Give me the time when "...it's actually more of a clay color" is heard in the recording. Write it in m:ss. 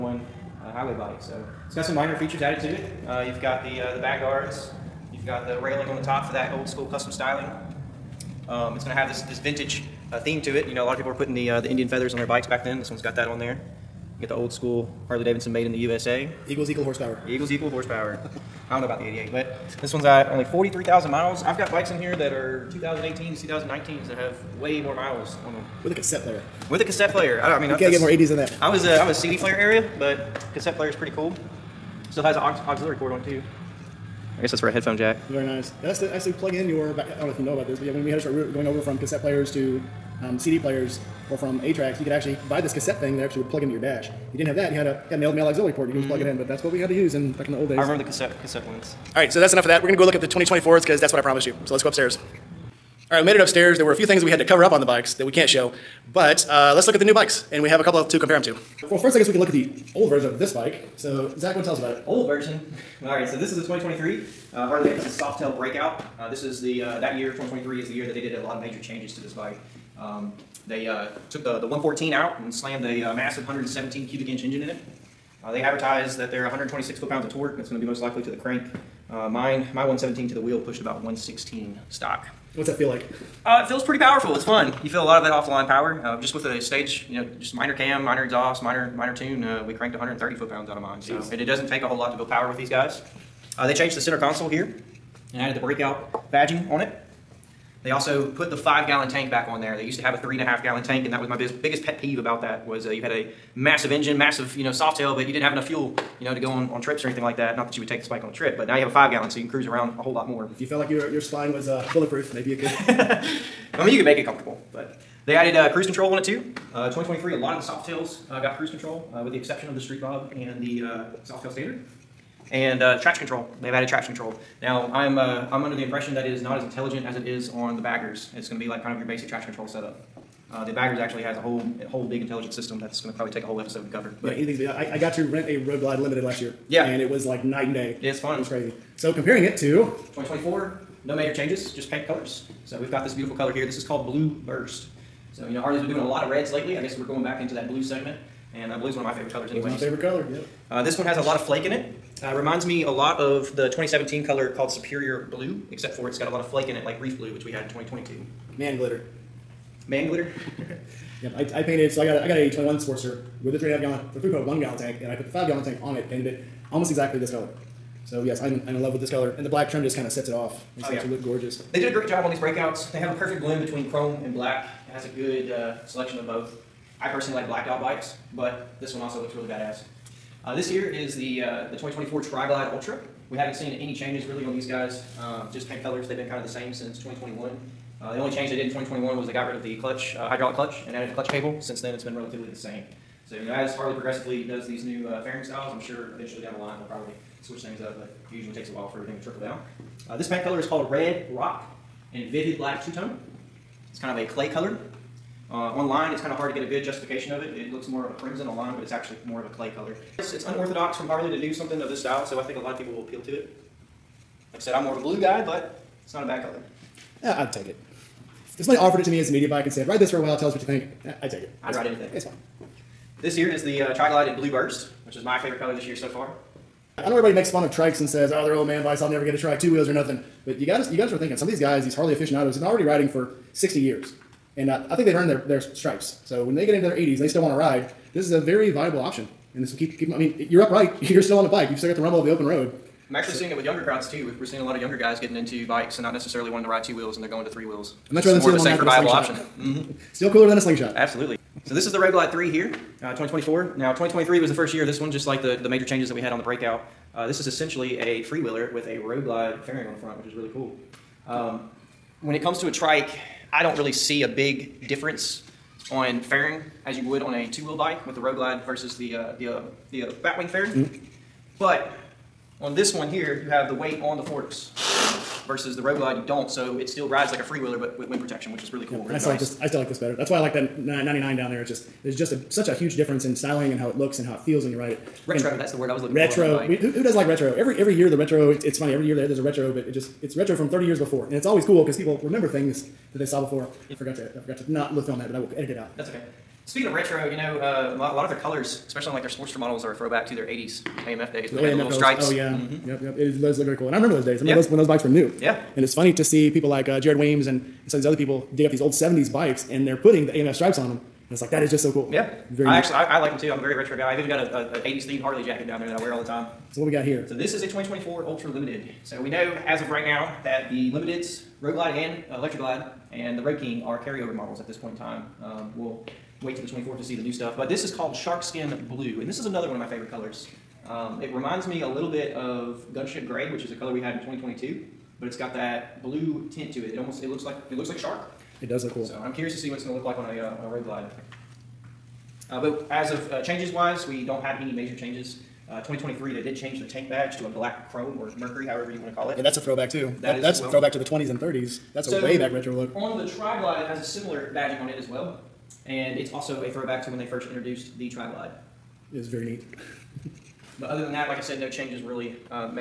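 3:28.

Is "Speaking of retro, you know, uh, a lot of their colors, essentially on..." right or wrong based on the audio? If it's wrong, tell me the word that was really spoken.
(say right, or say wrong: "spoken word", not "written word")
wrong: "especially", not "essentially".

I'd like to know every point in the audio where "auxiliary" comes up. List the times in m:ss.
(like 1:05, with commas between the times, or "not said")
0:32, 0:45.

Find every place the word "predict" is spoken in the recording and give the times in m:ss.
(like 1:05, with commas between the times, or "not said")
not said.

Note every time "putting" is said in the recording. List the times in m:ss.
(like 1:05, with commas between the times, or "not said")
0:11, 5:09.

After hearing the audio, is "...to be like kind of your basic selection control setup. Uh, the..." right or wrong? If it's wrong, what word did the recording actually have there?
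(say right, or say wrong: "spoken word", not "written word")
wrong: "traction", not "selection".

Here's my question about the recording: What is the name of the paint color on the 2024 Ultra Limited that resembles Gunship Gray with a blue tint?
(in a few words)
Shark Skin Blue.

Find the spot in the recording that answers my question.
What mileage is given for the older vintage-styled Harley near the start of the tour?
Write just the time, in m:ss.
0:20.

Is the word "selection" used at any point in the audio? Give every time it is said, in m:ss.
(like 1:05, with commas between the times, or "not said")
2:55.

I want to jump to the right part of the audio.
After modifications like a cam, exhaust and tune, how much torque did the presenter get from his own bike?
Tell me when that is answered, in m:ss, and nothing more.
1:29.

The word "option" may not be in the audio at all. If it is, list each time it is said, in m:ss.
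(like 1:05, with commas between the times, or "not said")
3:58, 4:09.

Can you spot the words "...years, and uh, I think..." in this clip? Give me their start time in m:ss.
3:53.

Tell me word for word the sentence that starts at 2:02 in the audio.
And uh, traction control, they've added traction control.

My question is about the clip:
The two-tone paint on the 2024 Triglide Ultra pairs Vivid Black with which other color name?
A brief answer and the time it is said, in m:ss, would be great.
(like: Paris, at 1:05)
Red Rock, at 3:20.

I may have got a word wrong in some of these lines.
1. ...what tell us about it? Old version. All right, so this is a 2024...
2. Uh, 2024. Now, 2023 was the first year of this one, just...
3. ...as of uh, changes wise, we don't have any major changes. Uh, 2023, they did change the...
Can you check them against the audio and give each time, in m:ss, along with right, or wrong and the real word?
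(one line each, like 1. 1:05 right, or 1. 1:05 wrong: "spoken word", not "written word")
1. 1:01 wrong: "2023", not "2024"
2. 4:13 right
3. 5:42 right.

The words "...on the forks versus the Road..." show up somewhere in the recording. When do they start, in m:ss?
4:34.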